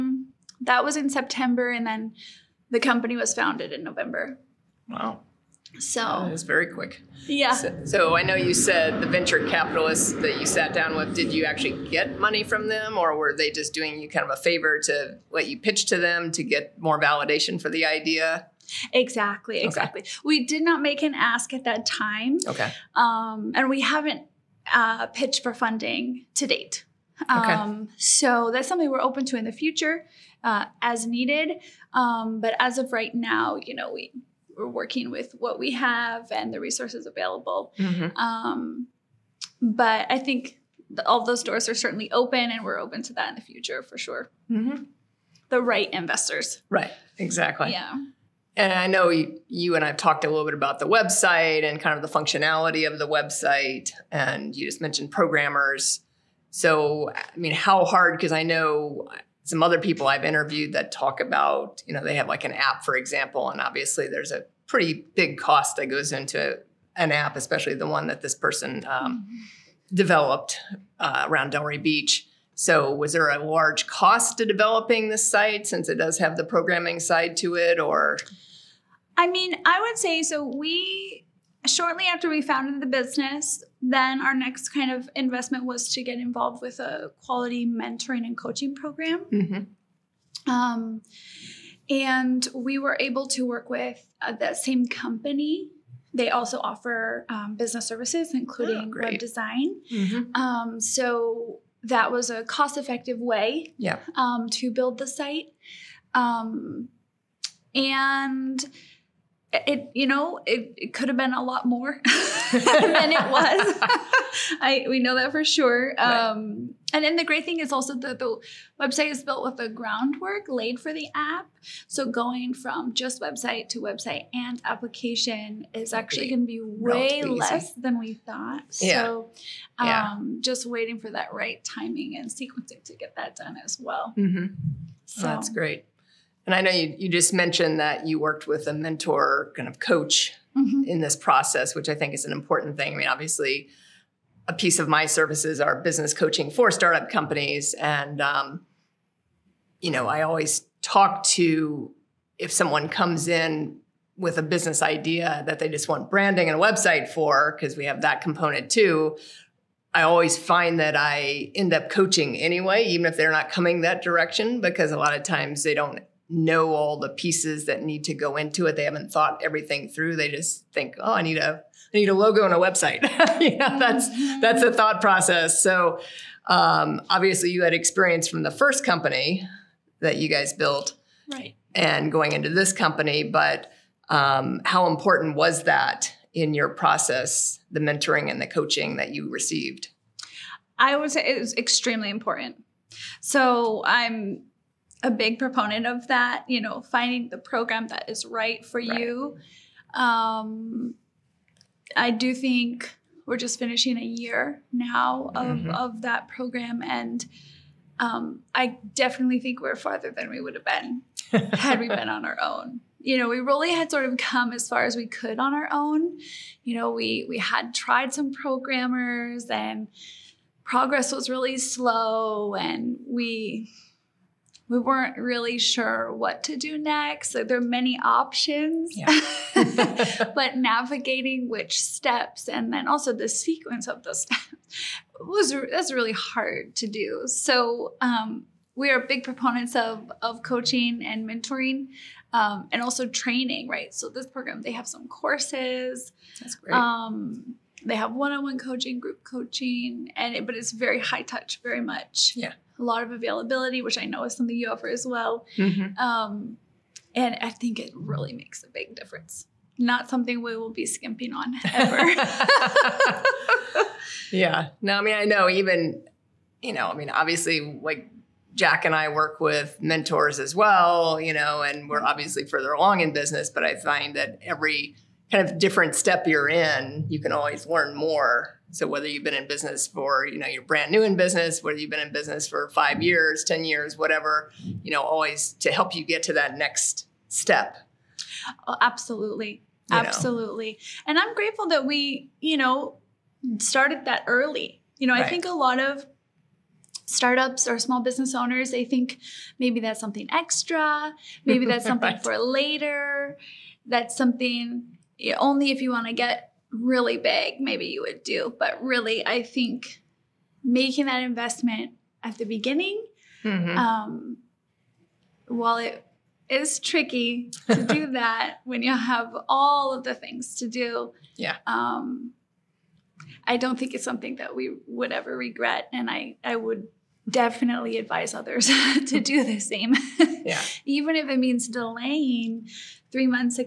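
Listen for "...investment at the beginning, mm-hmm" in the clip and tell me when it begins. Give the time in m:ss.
5:11.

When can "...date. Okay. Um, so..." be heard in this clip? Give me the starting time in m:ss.
0:26.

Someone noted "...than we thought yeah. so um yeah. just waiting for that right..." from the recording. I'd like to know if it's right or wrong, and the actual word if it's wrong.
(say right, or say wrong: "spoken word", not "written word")
right.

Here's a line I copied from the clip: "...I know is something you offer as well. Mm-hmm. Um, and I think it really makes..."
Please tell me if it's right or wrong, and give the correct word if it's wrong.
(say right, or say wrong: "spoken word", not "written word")
right.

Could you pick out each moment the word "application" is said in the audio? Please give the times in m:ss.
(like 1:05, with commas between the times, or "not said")
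2:04.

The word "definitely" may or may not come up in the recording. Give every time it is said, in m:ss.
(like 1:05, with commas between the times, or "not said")
3:28, 5:27.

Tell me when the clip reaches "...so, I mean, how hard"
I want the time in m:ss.
0:56.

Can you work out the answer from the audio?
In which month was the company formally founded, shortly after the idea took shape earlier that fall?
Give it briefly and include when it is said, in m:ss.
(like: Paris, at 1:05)
November, at 0:03.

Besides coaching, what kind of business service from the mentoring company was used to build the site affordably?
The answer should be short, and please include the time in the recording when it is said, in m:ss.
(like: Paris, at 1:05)
Web design, at 1:39.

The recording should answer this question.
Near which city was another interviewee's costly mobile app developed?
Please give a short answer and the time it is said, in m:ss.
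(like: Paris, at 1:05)
Delray Beach, at 1:11.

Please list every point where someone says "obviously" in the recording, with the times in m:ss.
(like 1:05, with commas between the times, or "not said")
1:03, 2:23, 2:57, 4:27, 4:32.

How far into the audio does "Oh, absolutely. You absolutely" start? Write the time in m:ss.
4:48.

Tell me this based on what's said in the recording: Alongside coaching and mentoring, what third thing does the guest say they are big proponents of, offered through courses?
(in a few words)
Training.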